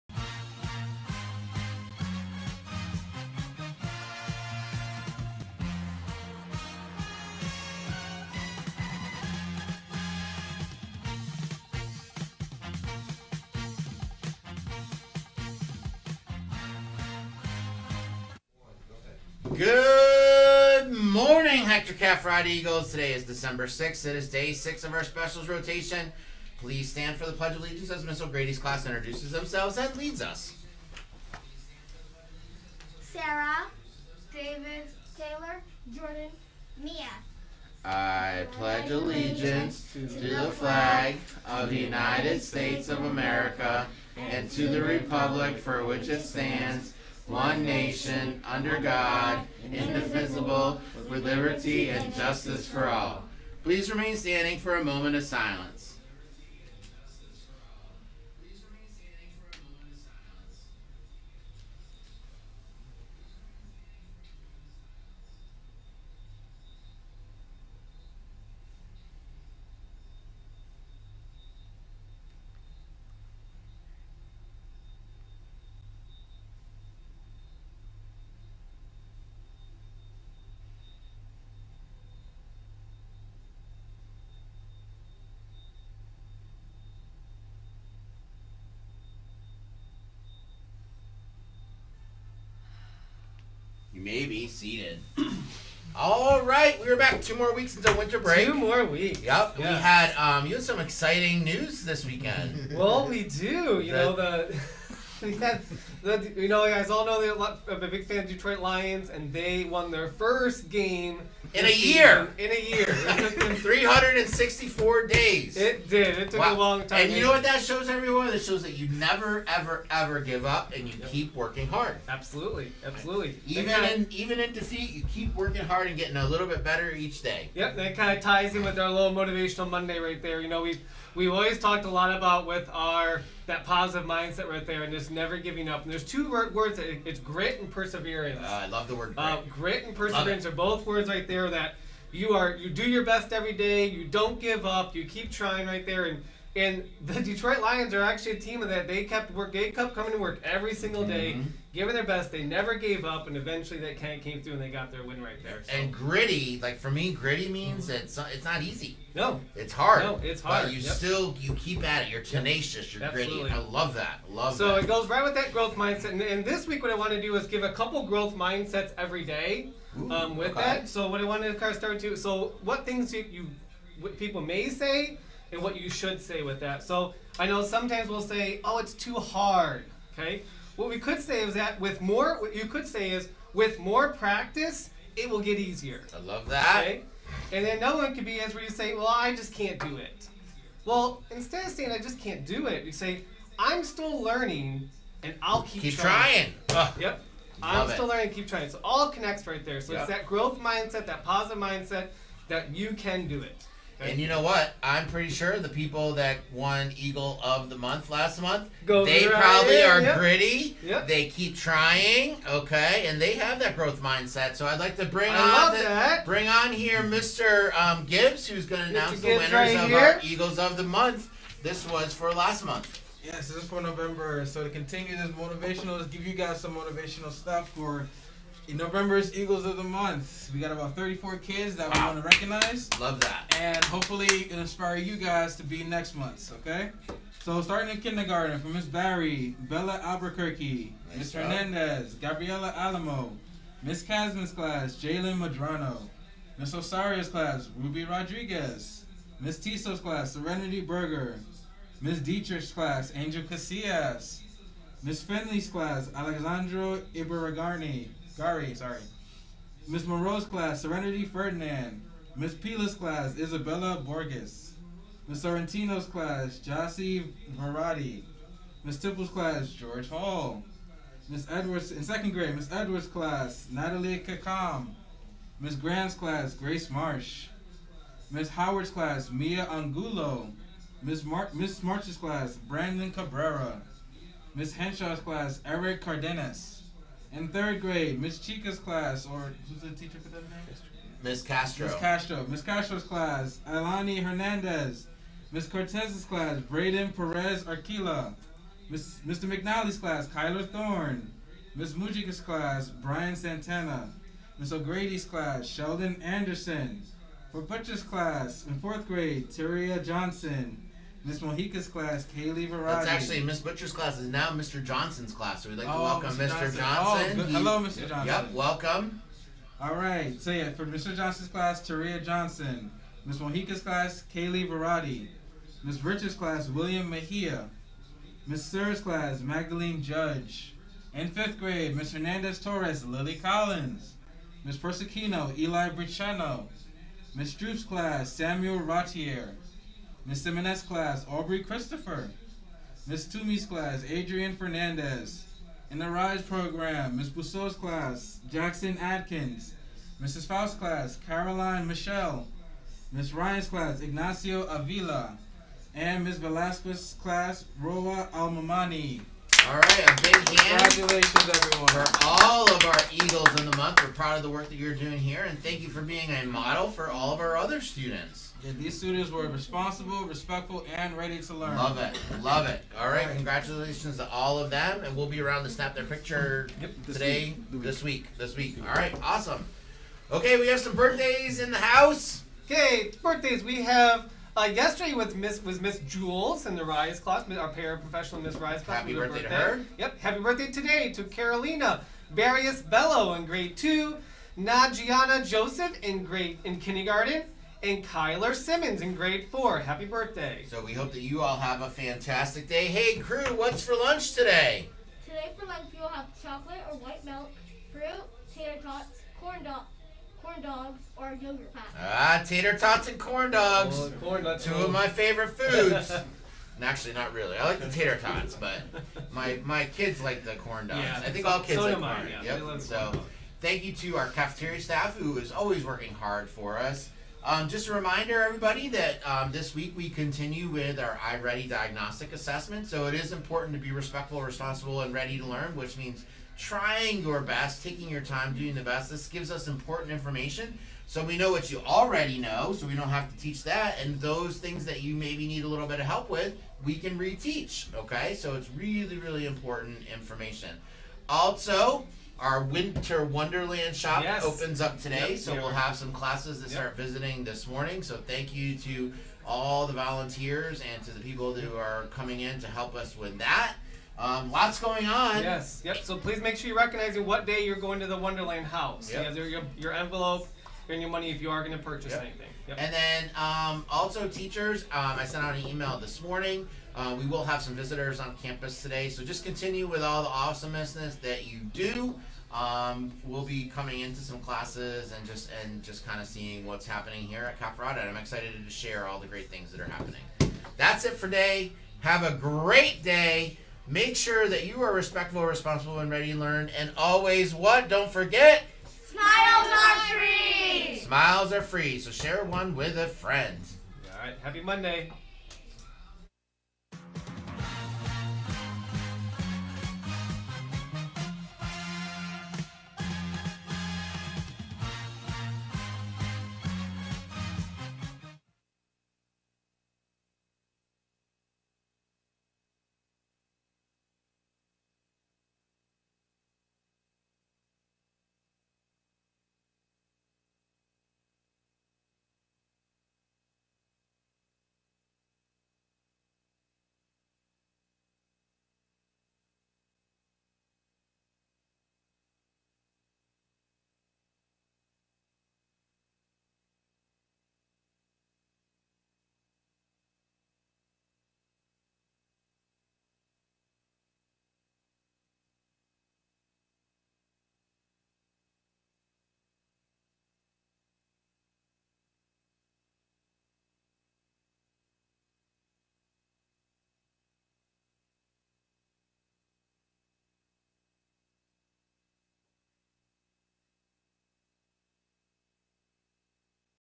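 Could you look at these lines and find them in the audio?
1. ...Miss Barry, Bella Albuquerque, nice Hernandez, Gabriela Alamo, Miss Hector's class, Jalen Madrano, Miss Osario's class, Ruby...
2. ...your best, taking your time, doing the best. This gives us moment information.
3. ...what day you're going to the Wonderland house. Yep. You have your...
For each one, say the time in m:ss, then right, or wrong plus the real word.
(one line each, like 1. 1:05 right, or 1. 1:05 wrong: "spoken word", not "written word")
1. 3:58 wrong: "Casman", not "Hector"
2. 7:17 wrong: "important", not "moment"
3. 7:47 right.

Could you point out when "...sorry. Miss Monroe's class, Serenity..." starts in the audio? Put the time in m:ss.
4:18.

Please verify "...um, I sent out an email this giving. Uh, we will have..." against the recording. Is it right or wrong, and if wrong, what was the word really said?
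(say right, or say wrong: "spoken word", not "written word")
wrong: "morning", not "giving".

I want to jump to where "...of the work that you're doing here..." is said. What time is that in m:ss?
6:04.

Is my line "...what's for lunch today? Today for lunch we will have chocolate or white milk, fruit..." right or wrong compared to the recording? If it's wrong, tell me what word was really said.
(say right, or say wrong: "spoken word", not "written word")
right.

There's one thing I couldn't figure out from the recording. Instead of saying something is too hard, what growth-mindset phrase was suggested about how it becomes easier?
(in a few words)
With more practice.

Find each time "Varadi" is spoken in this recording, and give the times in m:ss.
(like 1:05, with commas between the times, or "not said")
5:12, 5:24.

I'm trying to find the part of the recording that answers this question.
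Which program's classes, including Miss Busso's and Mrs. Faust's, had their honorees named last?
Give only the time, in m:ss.
5:46.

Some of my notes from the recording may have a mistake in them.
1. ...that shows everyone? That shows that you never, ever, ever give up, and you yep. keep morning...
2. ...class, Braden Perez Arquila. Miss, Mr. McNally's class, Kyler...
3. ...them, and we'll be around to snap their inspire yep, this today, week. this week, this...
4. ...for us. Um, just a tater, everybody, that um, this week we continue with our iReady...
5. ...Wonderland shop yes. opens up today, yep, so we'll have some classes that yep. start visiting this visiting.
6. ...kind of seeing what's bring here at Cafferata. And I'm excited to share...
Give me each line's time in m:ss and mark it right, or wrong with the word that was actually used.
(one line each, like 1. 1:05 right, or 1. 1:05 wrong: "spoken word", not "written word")
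1. 1:57 wrong: "working", not "morning"
2. 4:56 right
3. 6:14 wrong: "picture", not "inspire"
4. 7:06 wrong: "reminder", not "tater"
5. 7:33 wrong: "morning", not "visiting"
6. 8:06 wrong: "happening", not "bring".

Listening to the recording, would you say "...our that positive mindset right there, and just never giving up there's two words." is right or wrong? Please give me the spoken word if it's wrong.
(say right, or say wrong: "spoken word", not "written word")
right.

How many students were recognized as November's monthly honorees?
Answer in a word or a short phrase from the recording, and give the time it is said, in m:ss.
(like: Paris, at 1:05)
34, at 3:50.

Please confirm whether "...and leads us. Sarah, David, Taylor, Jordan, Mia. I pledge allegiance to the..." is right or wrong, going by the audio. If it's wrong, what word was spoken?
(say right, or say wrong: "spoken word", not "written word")
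right.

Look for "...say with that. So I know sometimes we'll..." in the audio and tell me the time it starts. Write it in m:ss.
2:56.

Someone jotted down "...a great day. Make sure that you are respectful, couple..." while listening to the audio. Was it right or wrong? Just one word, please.
wrong.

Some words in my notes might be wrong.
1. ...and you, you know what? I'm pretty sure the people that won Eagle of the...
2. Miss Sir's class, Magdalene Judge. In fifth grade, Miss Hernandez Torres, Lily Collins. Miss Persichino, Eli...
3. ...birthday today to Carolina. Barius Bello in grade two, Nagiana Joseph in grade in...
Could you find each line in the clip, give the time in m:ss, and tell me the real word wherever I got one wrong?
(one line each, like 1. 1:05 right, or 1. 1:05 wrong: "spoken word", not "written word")
1. 3:24 right
2. 5:28 right
3. 6:30 right.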